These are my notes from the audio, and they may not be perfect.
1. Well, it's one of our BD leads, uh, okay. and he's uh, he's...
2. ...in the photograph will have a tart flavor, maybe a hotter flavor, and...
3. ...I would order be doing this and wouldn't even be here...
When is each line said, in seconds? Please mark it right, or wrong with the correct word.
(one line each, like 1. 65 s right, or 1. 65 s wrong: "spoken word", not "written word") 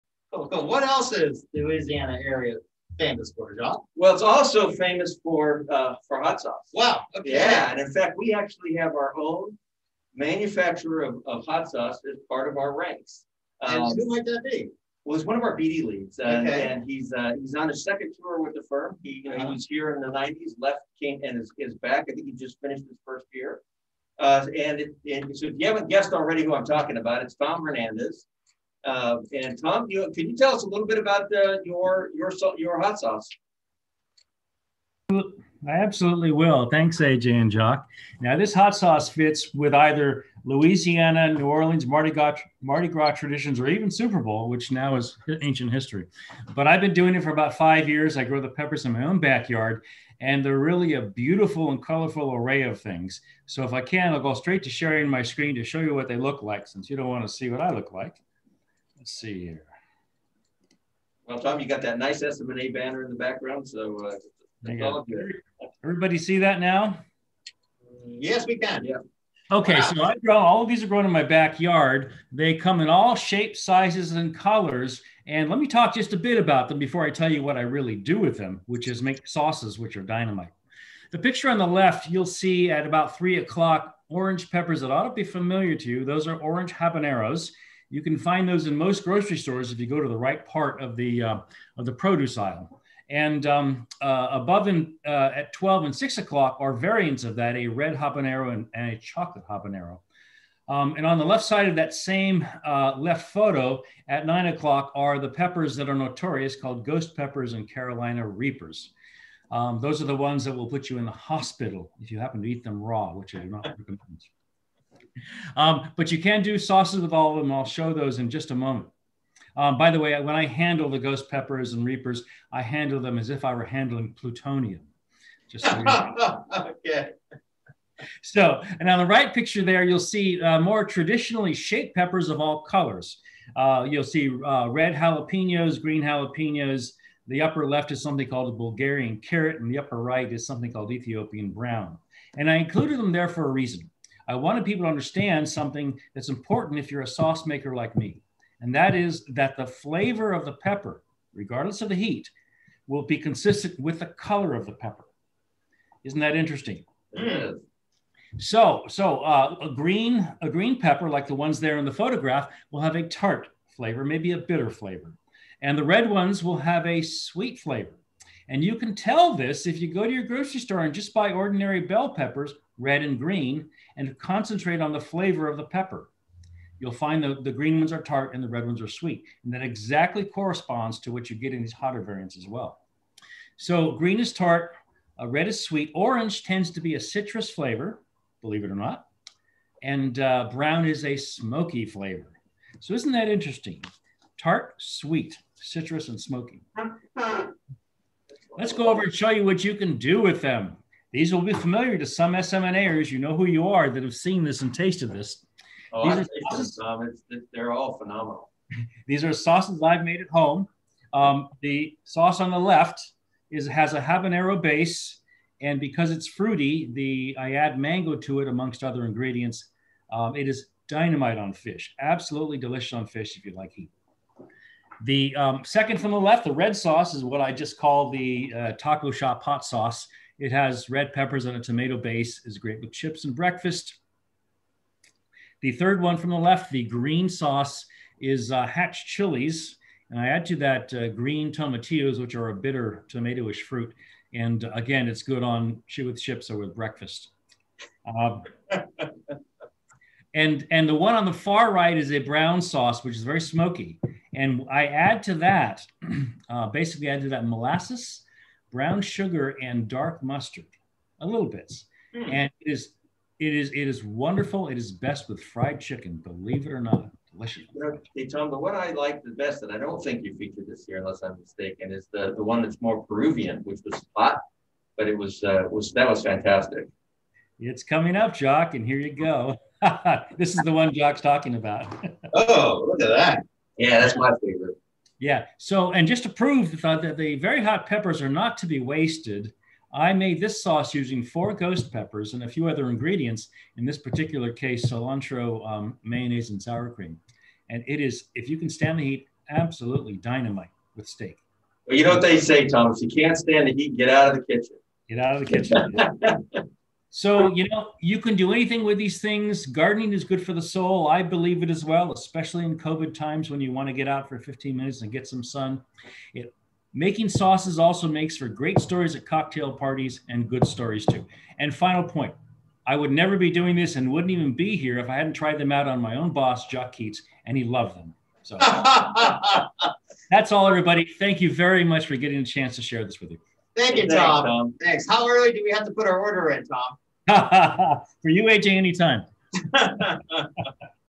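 1. 15 s right
2. 161 s wrong: "bitter", not "hotter"
3. 322 s wrong: "never", not "order".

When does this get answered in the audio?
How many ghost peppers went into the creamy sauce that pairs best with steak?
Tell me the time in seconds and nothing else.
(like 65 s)
291 s.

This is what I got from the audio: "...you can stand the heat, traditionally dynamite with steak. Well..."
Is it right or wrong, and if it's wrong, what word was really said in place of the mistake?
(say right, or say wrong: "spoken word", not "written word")
wrong: "absolutely", not "traditionally".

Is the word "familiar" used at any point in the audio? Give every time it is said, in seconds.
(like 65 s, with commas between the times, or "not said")
85 s, 201 s.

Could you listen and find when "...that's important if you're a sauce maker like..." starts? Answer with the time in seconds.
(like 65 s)
146 s.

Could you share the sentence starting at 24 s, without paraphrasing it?
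Uh, and, it, and so, if you haven't guessed already who I'm talking about, it's Tom Hernandez.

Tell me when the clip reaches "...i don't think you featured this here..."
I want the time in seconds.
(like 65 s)
269 s.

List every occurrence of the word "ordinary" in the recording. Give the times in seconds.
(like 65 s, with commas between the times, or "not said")
171 s.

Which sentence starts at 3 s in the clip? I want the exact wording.
Well, it's also famous for uh, for hot sauce.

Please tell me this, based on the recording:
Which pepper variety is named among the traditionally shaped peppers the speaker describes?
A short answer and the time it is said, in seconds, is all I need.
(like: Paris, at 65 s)
Bulgarian carrot, at 138 s.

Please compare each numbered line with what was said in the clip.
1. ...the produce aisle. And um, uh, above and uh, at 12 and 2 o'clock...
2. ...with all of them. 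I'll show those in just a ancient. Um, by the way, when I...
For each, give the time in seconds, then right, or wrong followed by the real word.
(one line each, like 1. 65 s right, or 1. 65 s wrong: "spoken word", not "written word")
1. 91 s wrong: "6", not "2"
2. 117 s wrong: "moment", not "ancient".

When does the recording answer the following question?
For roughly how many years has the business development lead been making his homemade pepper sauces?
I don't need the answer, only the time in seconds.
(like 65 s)
47 s.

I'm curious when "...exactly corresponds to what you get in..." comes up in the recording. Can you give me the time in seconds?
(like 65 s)
179 s.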